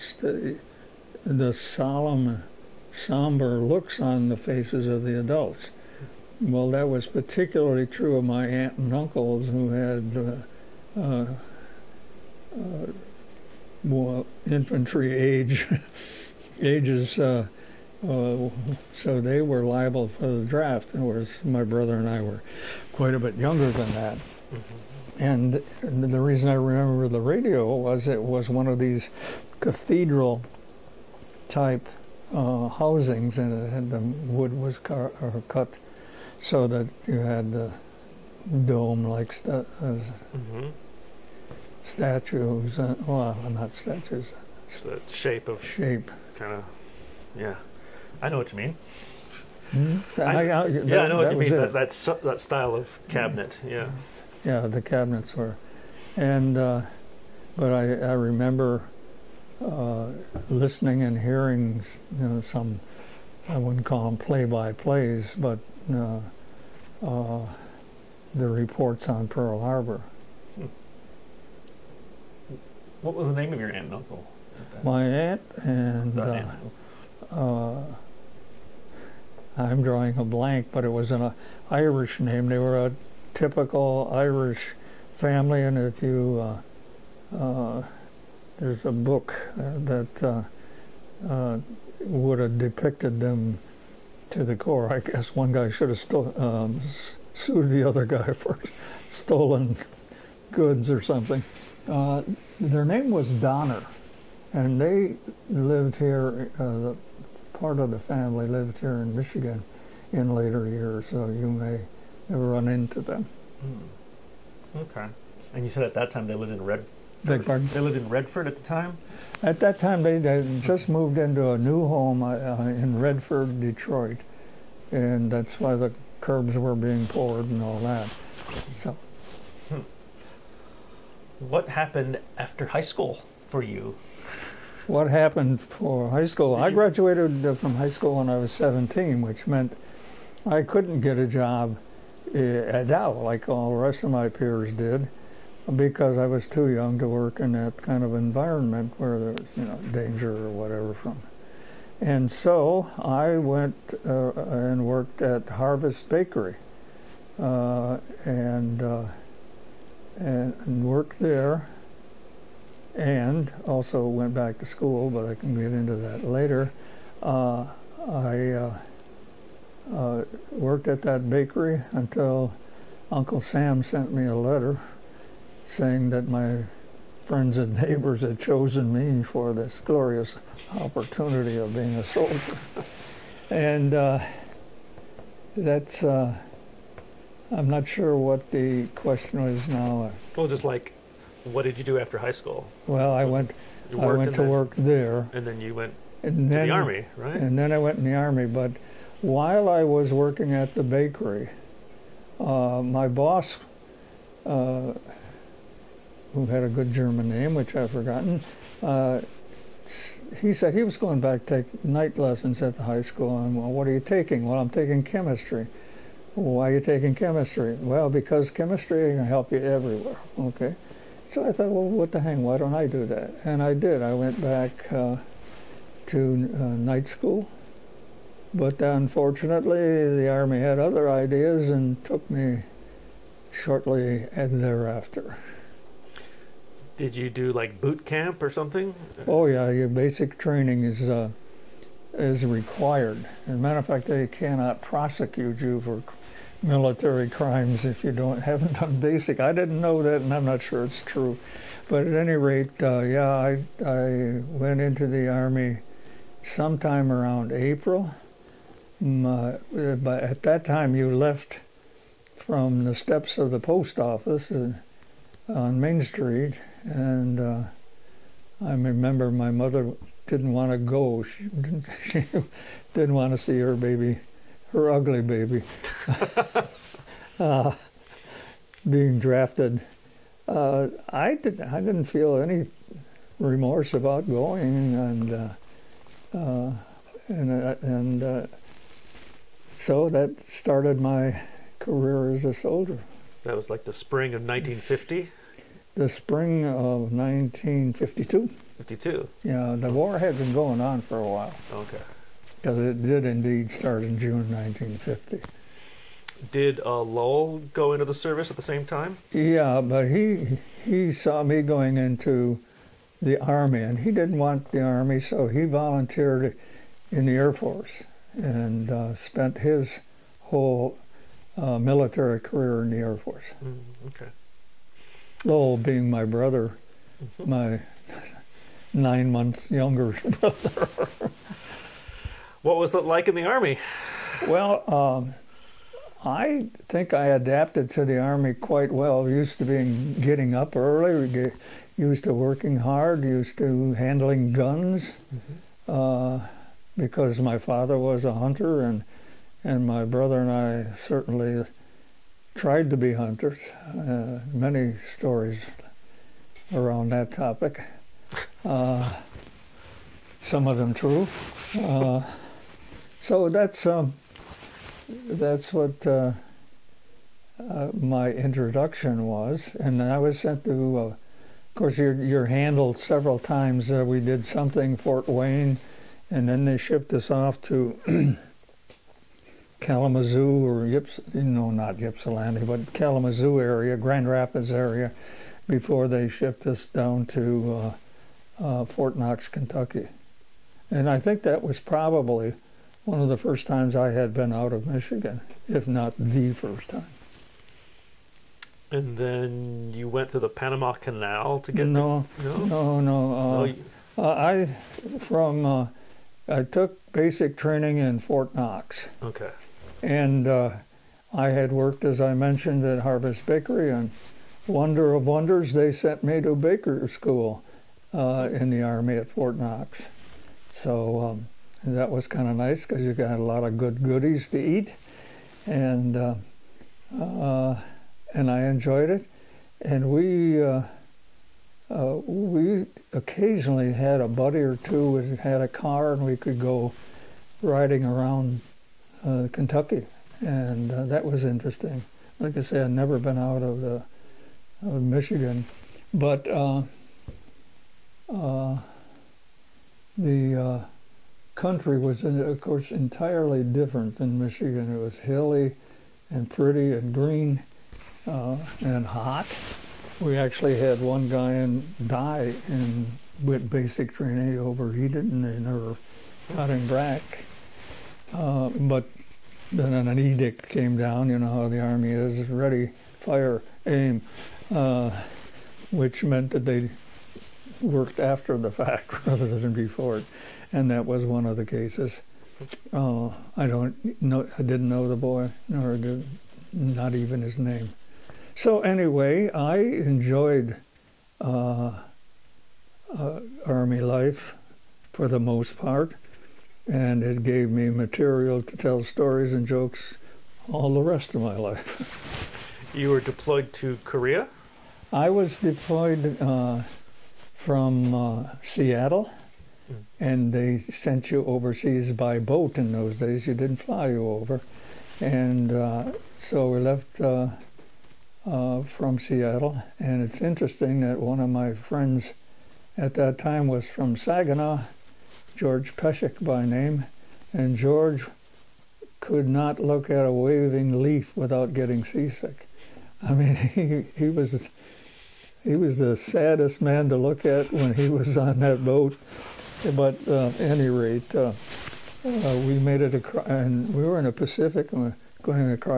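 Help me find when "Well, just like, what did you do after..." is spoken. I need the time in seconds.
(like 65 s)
190 s.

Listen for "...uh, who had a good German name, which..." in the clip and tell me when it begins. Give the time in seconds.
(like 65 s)
204 s.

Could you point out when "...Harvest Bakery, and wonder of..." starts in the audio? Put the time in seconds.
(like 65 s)
412 s.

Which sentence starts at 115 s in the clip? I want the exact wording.
And you said at that time they lived in Red Beg pardon?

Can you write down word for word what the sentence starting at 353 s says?
Uh, many stories around that topic.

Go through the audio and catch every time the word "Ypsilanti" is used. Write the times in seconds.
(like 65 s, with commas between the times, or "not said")
382 s.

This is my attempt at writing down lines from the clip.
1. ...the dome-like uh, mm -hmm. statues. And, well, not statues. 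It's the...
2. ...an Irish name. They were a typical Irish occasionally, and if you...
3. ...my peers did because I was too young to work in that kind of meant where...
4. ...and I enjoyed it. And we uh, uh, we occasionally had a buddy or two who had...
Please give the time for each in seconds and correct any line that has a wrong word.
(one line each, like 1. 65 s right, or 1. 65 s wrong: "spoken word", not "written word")
1. 37 s right
2. 81 s wrong: "family", not "occasionally"
3. 144 s wrong: "environment", not "meant"
4. 428 s right.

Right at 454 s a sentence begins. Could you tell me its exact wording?
It was hilly and pretty and green and hot.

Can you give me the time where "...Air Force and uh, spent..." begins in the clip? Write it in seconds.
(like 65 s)
317 s.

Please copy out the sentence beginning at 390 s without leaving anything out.
And I think that was probably one of the first times I had been out of Michigan, if not the first time.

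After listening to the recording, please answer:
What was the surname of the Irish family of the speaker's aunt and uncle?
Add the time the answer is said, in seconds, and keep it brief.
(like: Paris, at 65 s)
Donner, at 103 s.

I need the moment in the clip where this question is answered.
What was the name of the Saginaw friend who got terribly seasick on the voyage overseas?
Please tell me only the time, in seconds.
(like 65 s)
525 s.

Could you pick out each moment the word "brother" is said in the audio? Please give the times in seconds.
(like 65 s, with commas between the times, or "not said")
21 s, 326 s, 330 s, 350 s.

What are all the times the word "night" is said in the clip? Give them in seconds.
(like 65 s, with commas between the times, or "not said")
211 s, 226 s.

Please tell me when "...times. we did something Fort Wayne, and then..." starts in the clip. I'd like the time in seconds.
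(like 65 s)
373 s.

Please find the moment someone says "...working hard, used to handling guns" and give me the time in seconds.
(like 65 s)
342 s.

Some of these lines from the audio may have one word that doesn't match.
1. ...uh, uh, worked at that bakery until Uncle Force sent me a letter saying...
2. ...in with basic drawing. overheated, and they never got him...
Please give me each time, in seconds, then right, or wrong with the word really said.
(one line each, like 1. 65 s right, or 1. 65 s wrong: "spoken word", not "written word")
1. 168 s wrong: "Sam", not "Force"
2. 462 s wrong: "training", not "drawing".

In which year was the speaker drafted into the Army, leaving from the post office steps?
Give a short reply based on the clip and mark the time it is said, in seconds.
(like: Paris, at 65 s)
1952, at 297 s.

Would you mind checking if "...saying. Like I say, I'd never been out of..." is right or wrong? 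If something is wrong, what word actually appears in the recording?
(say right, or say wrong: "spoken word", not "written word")
wrong: "interesting", not "saying".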